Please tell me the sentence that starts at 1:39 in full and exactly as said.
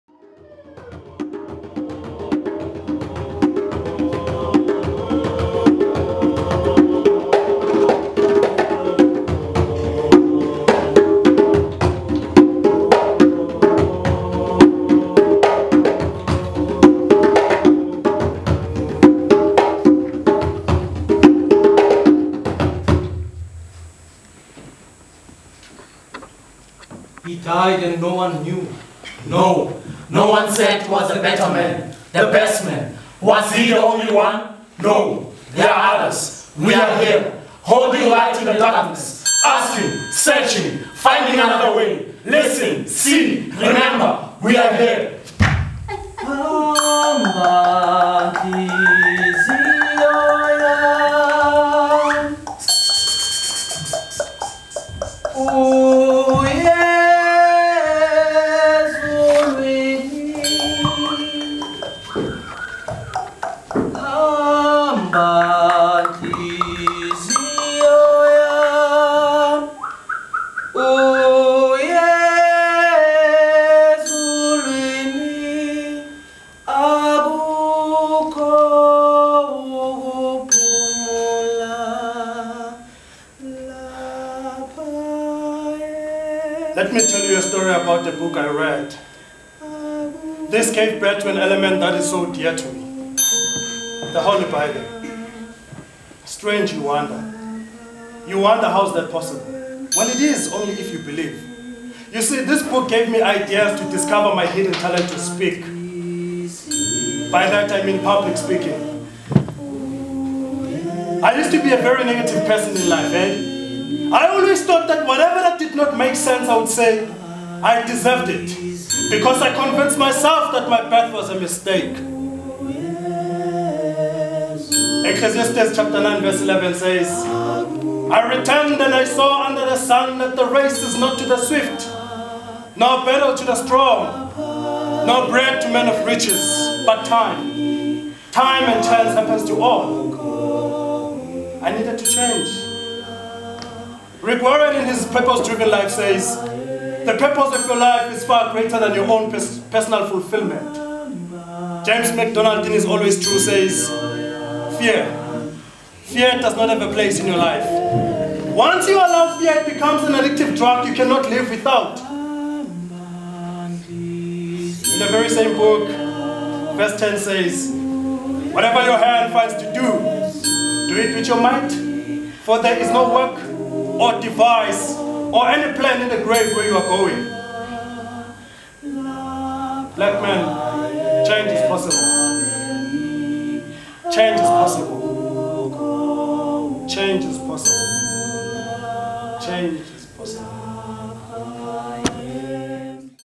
Well, it is only if you believe.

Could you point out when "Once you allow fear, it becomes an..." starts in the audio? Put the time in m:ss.
2:38.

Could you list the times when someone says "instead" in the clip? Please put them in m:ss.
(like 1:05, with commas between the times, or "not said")
not said.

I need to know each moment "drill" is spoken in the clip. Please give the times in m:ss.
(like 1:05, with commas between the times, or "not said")
not said.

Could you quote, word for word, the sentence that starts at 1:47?
By that I mean public speaking.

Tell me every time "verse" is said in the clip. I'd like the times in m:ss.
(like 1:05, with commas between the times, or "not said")
2:06, 2:46.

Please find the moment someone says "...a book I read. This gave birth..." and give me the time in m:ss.
1:28.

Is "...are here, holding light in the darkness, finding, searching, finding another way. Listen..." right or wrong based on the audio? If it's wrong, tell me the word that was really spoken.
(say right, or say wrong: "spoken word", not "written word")
wrong: "asking", not "finding".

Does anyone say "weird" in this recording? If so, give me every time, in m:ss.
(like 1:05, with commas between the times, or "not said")
not said.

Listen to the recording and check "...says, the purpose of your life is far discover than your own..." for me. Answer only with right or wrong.
wrong.